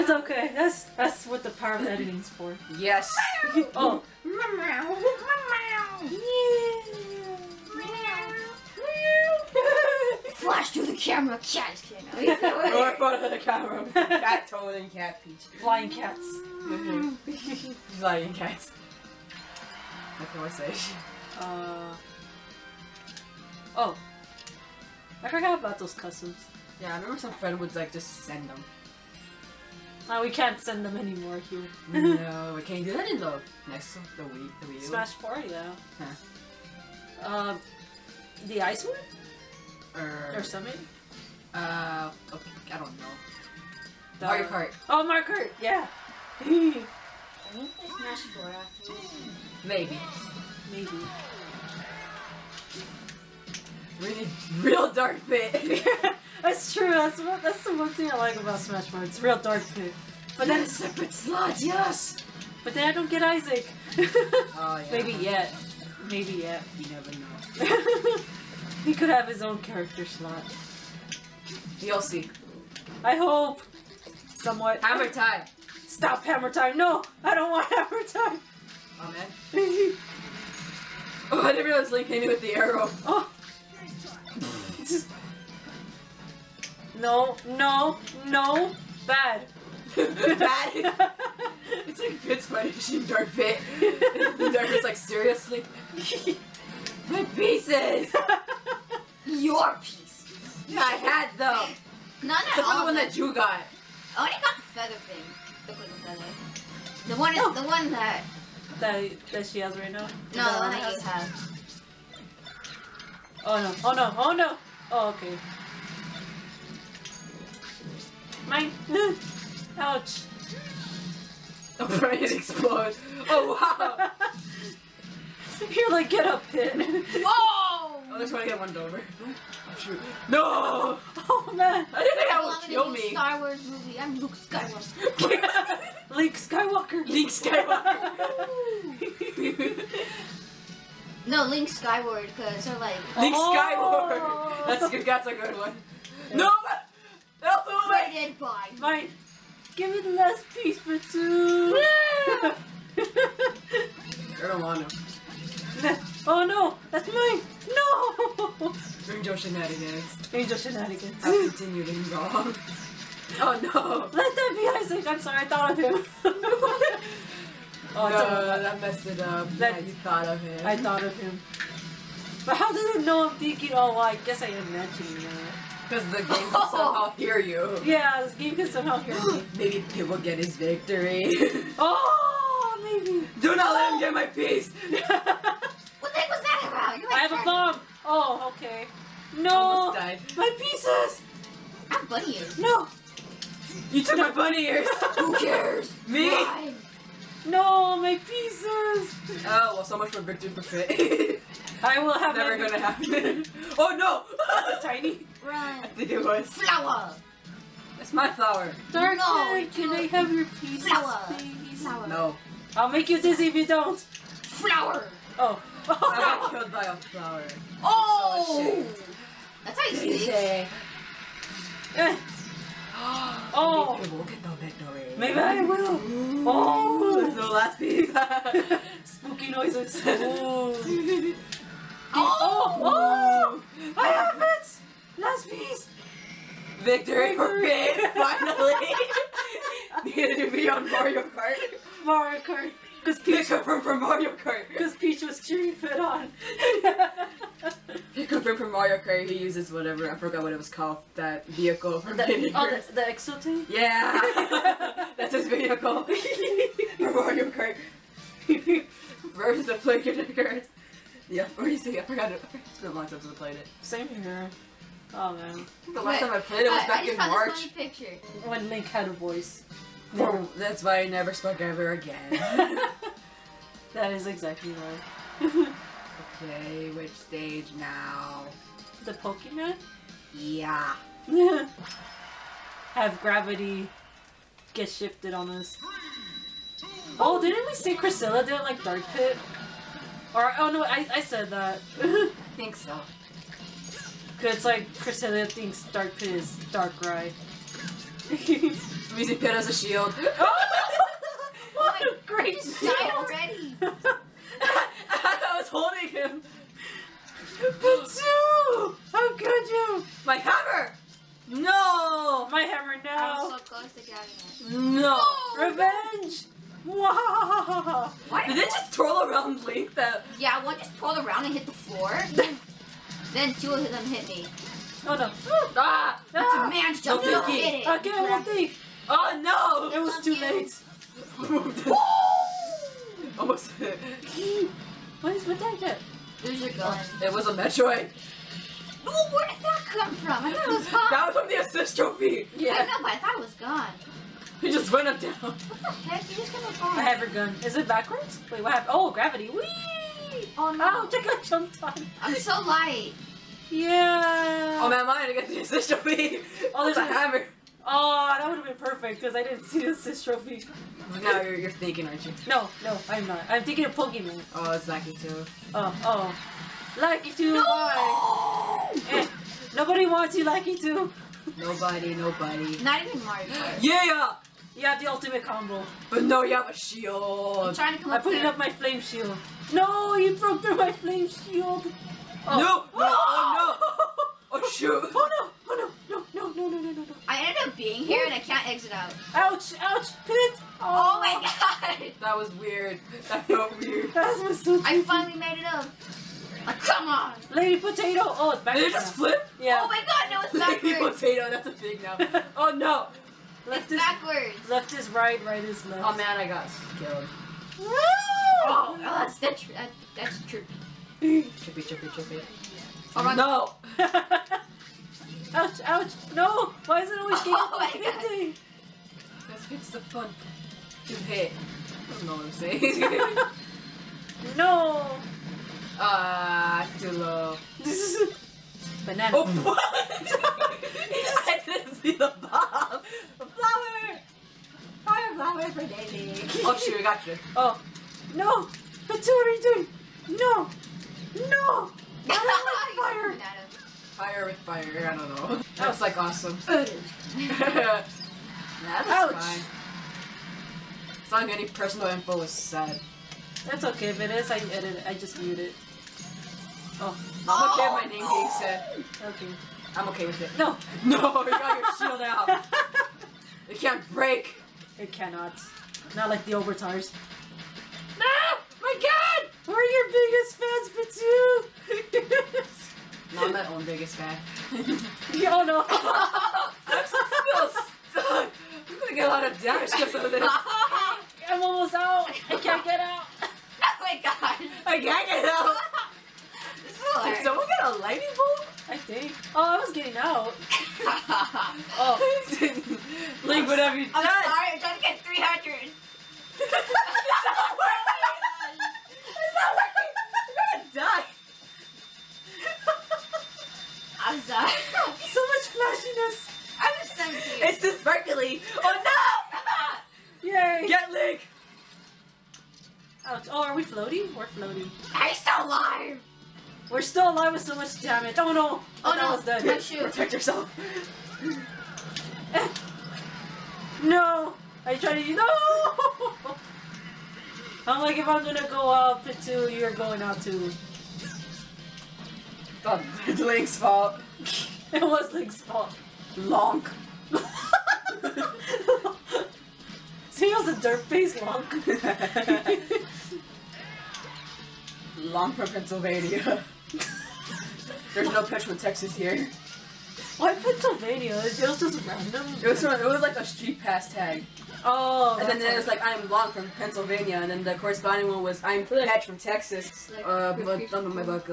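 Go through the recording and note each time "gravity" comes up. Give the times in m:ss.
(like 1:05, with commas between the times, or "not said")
4:43, 5:49.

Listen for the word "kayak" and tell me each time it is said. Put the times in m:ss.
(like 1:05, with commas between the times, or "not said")
not said.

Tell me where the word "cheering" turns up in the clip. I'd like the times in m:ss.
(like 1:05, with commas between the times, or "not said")
4:05.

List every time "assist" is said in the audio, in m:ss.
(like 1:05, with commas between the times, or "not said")
5:41, 5:55, 5:59.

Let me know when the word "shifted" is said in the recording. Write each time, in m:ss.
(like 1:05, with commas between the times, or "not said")
4:44.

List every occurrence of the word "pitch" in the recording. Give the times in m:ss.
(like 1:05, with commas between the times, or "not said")
9:08.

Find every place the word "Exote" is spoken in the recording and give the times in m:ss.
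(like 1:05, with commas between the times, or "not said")
4:13.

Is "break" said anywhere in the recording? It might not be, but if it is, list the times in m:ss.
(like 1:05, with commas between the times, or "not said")
7:44.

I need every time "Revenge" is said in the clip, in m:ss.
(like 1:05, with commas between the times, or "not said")
5:15.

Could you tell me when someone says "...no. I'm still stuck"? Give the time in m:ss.
7:55.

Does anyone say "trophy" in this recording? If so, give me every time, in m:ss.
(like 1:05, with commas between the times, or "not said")
5:41, 5:55, 6:00.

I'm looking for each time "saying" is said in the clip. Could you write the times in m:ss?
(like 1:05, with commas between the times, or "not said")
7:02.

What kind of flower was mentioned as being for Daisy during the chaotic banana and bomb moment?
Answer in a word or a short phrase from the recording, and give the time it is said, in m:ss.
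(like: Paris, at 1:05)
Fire flower, at 7:15.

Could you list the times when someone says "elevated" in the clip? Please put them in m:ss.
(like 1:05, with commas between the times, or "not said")
not said.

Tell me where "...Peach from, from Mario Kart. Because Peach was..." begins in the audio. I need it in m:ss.
4:03.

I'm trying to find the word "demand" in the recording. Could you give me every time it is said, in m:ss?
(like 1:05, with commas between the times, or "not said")
not said.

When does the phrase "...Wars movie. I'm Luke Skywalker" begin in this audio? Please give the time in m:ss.
2:13.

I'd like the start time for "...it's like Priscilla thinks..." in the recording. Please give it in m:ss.
4:54.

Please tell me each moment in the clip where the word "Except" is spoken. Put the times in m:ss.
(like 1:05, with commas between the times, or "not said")
1:42.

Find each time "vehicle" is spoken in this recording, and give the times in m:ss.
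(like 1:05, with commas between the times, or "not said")
4:11, 4:15.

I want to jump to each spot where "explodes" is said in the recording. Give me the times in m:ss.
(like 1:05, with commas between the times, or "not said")
2:02.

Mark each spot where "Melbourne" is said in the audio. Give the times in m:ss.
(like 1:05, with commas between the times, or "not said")
not said.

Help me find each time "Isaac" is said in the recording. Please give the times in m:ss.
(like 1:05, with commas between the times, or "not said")
1:03, 2:44.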